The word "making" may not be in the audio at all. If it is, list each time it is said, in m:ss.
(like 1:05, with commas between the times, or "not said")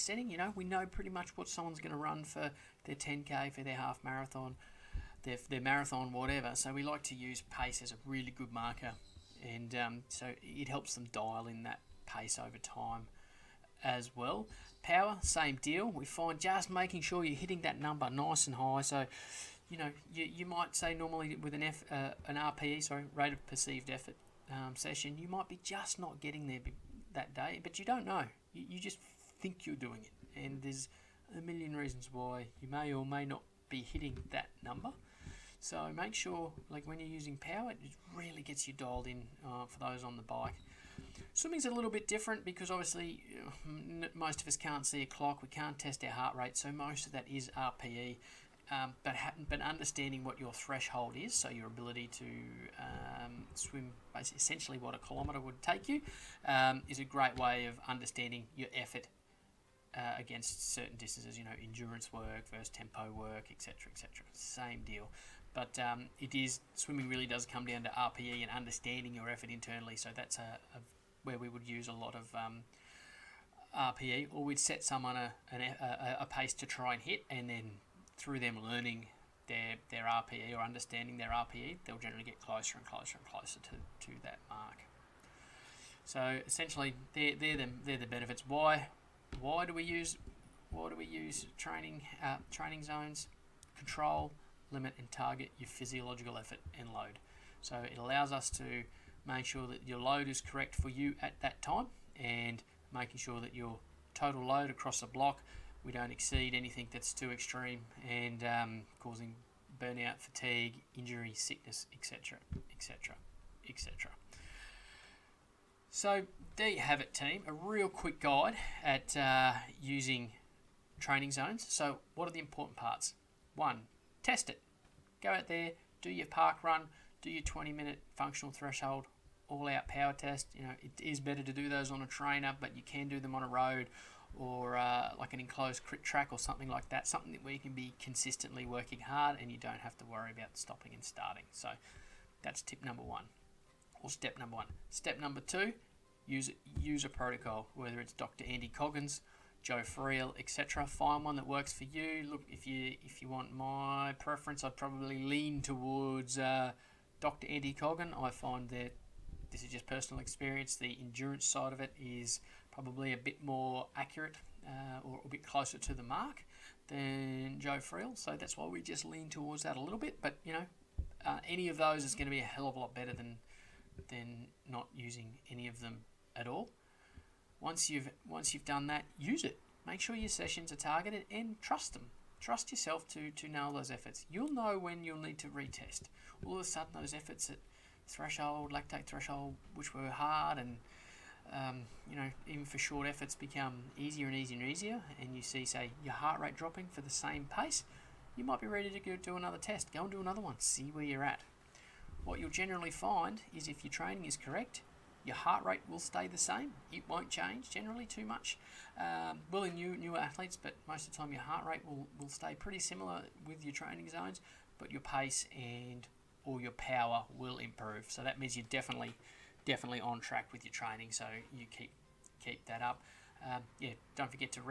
0:16, 1:42.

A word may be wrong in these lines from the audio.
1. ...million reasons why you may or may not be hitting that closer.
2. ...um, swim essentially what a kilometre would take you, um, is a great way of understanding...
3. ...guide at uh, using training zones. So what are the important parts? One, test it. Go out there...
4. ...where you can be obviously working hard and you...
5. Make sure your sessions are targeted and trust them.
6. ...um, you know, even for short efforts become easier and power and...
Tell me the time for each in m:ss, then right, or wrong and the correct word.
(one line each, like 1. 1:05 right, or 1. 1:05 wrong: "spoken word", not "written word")
1. 0:31 wrong: "number", not "closer"
2. 0:52 right
3. 1:58 right
4. 2:17 wrong: "consistently", not "obviously"
5. 2:59 right
6. 3:11 wrong: "easier", not "power".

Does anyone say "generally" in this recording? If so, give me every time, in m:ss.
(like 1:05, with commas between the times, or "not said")
1:21, 3:22, 3:27.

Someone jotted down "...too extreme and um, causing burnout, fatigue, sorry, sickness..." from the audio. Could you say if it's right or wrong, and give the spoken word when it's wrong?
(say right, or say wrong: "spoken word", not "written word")
wrong: "injury", not "sorry".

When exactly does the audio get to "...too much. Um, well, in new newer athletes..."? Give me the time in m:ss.
3:28.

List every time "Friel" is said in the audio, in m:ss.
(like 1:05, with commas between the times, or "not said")
2:29, 2:47.